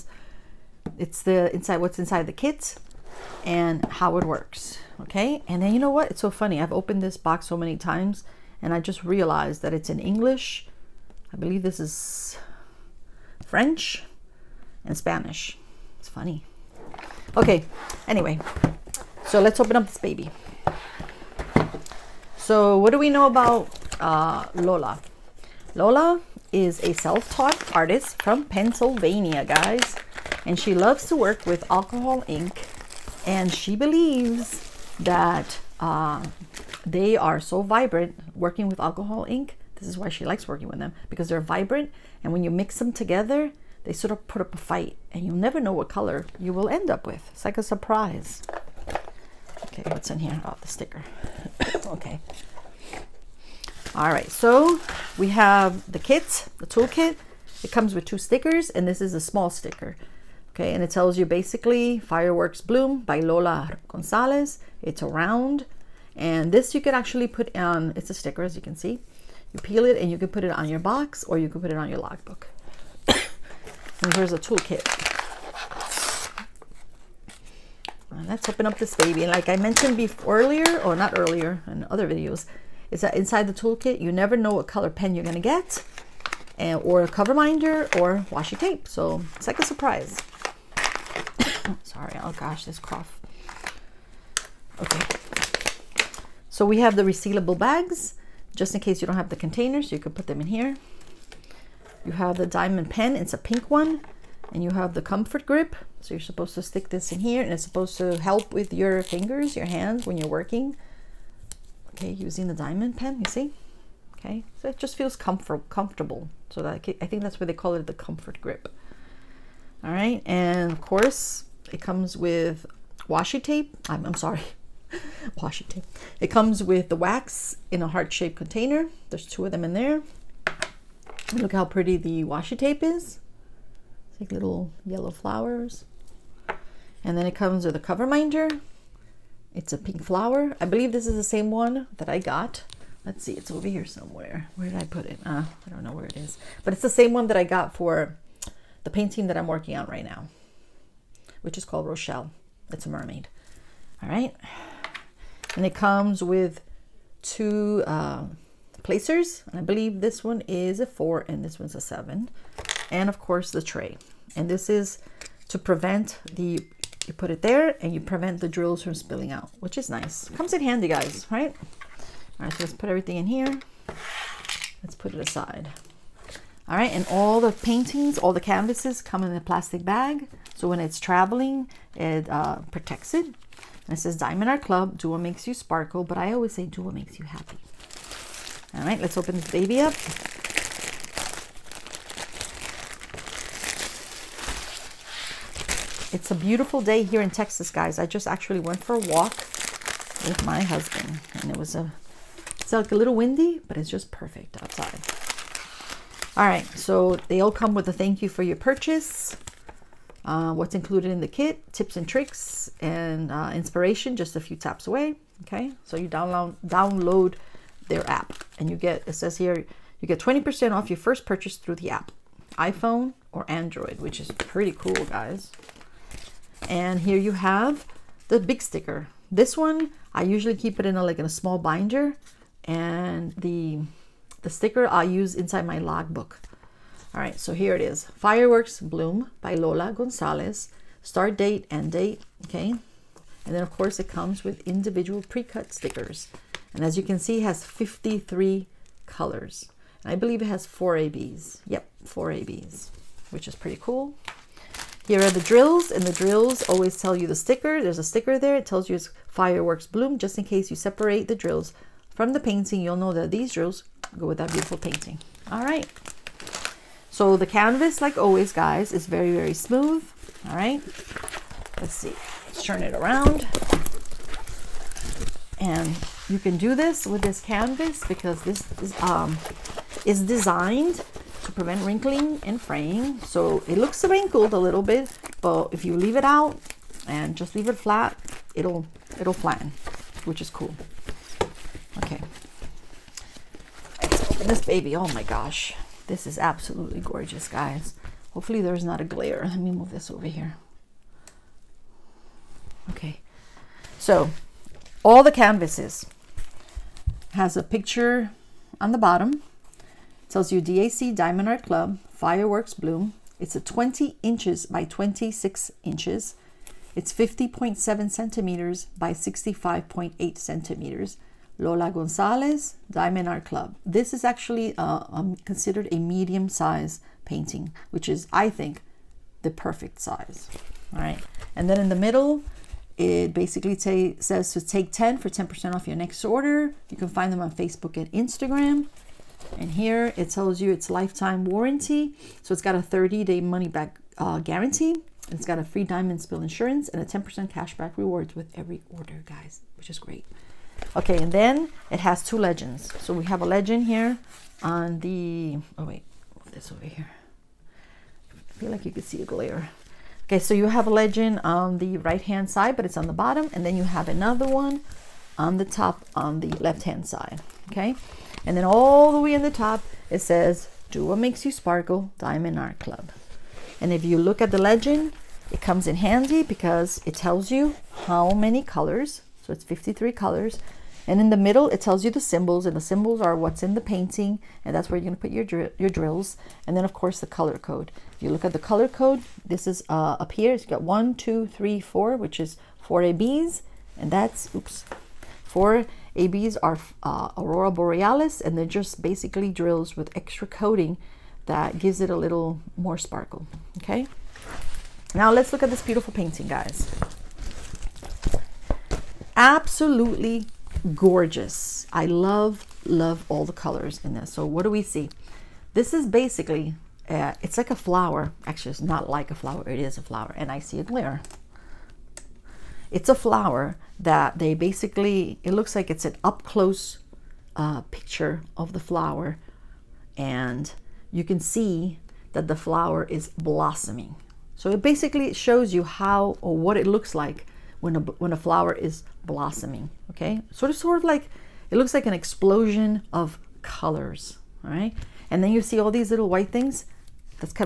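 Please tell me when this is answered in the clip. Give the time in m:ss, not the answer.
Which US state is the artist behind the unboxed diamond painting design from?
0:28.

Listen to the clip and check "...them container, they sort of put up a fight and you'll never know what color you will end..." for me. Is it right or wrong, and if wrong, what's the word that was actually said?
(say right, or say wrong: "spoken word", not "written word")
wrong: "together", not "container".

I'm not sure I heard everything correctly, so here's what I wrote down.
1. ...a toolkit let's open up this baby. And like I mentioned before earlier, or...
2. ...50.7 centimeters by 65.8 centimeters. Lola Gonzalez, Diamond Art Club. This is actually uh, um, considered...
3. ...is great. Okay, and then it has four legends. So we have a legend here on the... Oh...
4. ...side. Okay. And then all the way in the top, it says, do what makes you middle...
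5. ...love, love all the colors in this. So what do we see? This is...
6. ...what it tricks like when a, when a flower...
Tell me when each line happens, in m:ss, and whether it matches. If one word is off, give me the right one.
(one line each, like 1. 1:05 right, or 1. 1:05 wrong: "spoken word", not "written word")
1. 1:14 right
2. 5:17 right
3. 5:49 wrong: "two", not "four"
4. 6:07 wrong: "sparkle", not "middle"
5. 6:52 right
6. 7:16 wrong: "looks", not "tricks".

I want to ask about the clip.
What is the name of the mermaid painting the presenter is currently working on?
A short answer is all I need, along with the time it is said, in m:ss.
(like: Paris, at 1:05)
Rochelle, at 2:31.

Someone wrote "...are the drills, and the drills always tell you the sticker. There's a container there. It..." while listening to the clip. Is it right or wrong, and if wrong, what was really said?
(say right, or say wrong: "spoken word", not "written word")
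wrong: "sticker", not "container".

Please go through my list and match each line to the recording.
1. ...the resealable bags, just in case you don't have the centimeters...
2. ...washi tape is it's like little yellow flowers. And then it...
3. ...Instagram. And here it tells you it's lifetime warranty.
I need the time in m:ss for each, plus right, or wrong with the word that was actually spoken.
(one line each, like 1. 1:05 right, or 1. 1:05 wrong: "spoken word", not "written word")
1. 1:36 wrong: "containers", not "centimeters"
2. 2:12 right
3. 5:38 right.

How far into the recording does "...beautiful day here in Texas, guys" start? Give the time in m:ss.
3:16.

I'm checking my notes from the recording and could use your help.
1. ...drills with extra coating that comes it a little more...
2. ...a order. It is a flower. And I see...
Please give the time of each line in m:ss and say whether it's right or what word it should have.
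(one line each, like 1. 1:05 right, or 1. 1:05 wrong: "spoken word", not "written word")
1. 6:39 wrong: "gives", not "comes"
2. 6:59 wrong: "flower", not "order".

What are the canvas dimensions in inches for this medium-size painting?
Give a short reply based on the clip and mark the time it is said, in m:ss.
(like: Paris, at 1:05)
20 by 26 inches, at 5:13.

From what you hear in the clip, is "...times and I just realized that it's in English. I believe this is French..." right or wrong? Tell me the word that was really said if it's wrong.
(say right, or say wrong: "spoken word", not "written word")
right.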